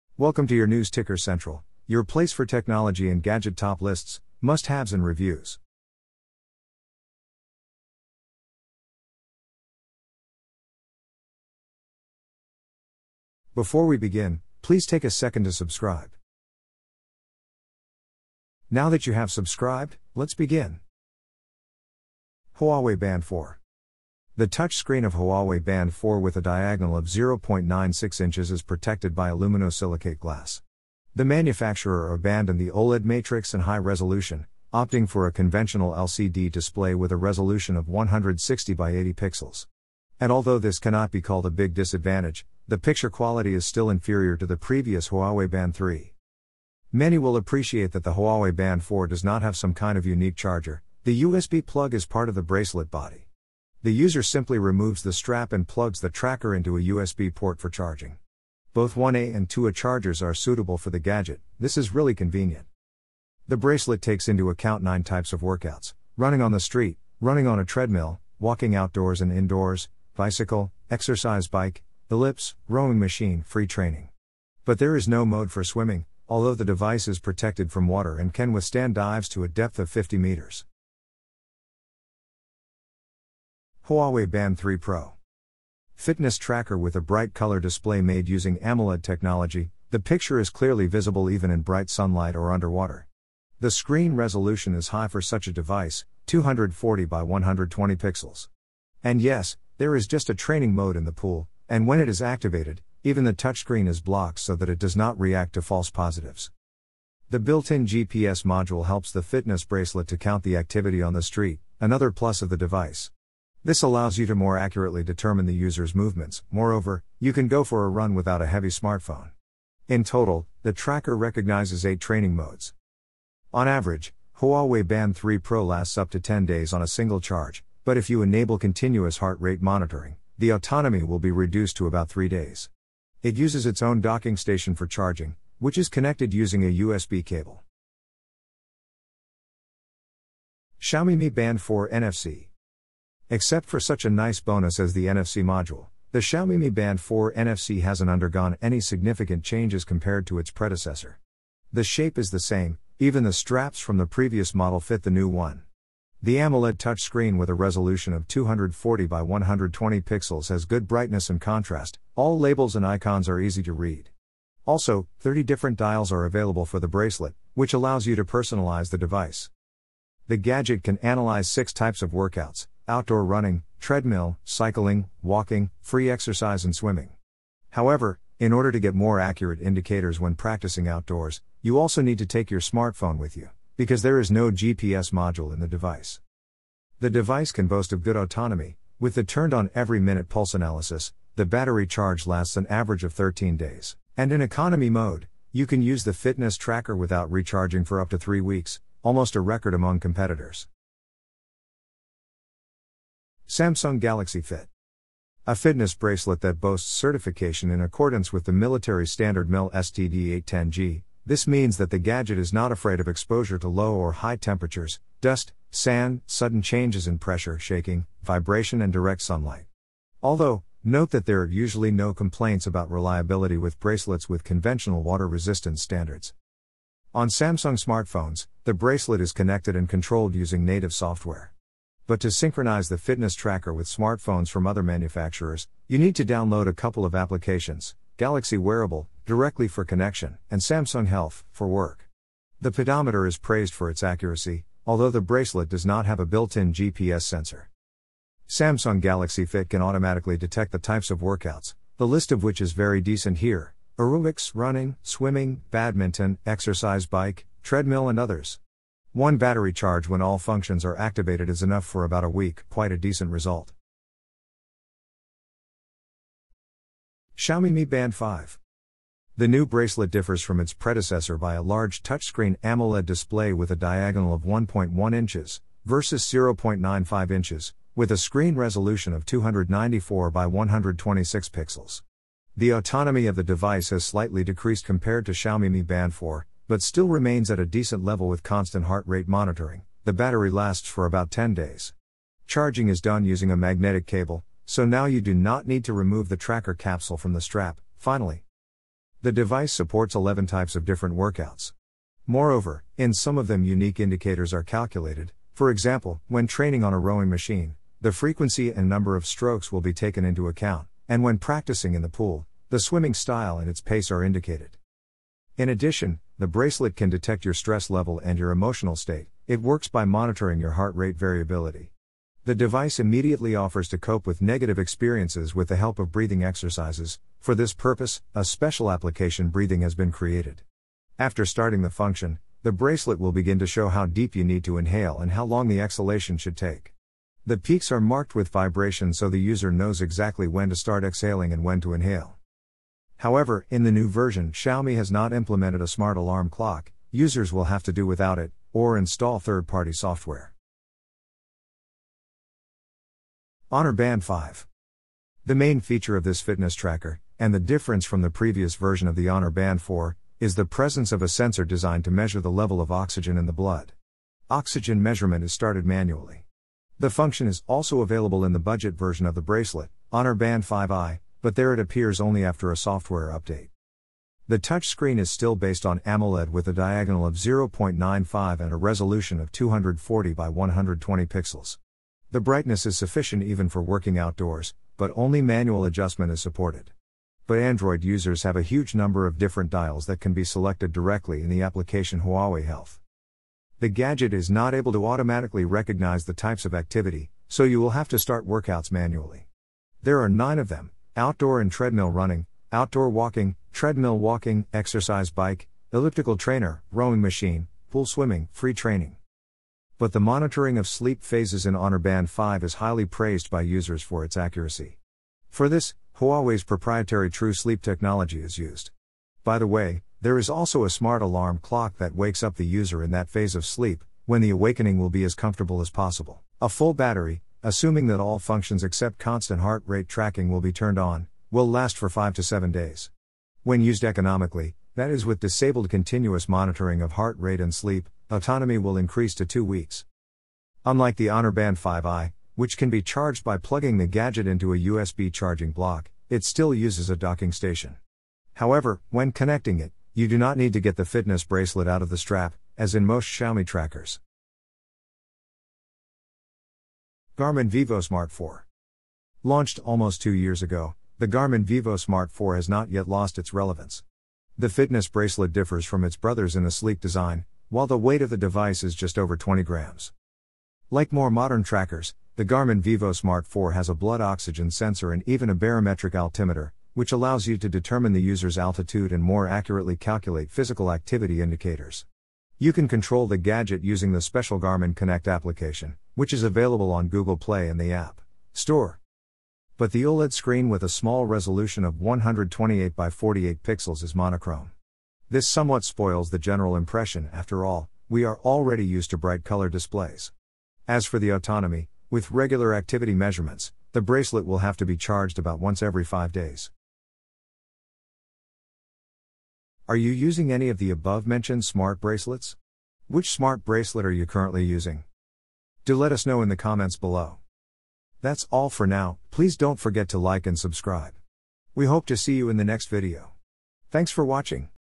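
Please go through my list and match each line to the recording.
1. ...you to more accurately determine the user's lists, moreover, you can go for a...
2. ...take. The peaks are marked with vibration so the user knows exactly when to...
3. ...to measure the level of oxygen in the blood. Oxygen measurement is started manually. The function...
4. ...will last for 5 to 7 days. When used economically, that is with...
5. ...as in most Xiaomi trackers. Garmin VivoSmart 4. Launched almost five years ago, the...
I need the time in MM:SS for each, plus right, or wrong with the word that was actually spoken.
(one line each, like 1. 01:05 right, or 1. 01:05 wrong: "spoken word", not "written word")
1. 01:54 wrong: "movements", not "lists"
2. 05:36 right
3. 06:02 right
4. 07:11 right
5. 07:32 wrong: "two", not "five".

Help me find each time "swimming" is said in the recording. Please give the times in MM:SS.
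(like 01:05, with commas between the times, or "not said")
01:15, 02:56, 04:15, 05:12, 06:48.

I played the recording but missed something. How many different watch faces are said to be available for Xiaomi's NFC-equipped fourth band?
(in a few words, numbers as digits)
30.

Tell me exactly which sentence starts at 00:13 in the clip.
Before we begin, please take a second to subscribe.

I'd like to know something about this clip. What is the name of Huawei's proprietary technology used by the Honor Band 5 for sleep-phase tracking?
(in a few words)
True Sleep.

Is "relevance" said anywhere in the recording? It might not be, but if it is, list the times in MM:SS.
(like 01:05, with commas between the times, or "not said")
07:43.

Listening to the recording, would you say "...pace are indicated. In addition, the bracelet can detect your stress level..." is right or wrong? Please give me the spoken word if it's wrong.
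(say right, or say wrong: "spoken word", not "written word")
right.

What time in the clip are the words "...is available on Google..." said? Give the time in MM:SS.
08:06.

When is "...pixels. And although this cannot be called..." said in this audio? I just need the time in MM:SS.
00:39.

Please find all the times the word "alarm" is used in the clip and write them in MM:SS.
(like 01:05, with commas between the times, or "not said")
05:46, 07:01.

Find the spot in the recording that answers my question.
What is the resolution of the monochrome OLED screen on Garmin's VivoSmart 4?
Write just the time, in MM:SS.
08:11.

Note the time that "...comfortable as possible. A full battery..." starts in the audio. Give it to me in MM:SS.
07:05.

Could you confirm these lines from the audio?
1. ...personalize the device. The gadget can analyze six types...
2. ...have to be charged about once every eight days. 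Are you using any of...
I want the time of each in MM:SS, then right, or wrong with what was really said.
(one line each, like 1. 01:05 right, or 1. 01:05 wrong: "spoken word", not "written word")
1. 02:48 right
2. 08:24 wrong: "five", not "eight".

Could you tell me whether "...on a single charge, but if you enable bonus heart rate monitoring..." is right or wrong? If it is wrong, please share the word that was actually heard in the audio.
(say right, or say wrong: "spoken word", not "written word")
wrong: "continuous", not "bonus".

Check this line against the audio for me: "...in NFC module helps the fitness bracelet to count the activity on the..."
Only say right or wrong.
wrong.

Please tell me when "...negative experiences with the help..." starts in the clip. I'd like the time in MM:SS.
05:24.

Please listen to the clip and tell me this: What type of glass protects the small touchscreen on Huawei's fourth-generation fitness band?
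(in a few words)
Aluminosilicate glass.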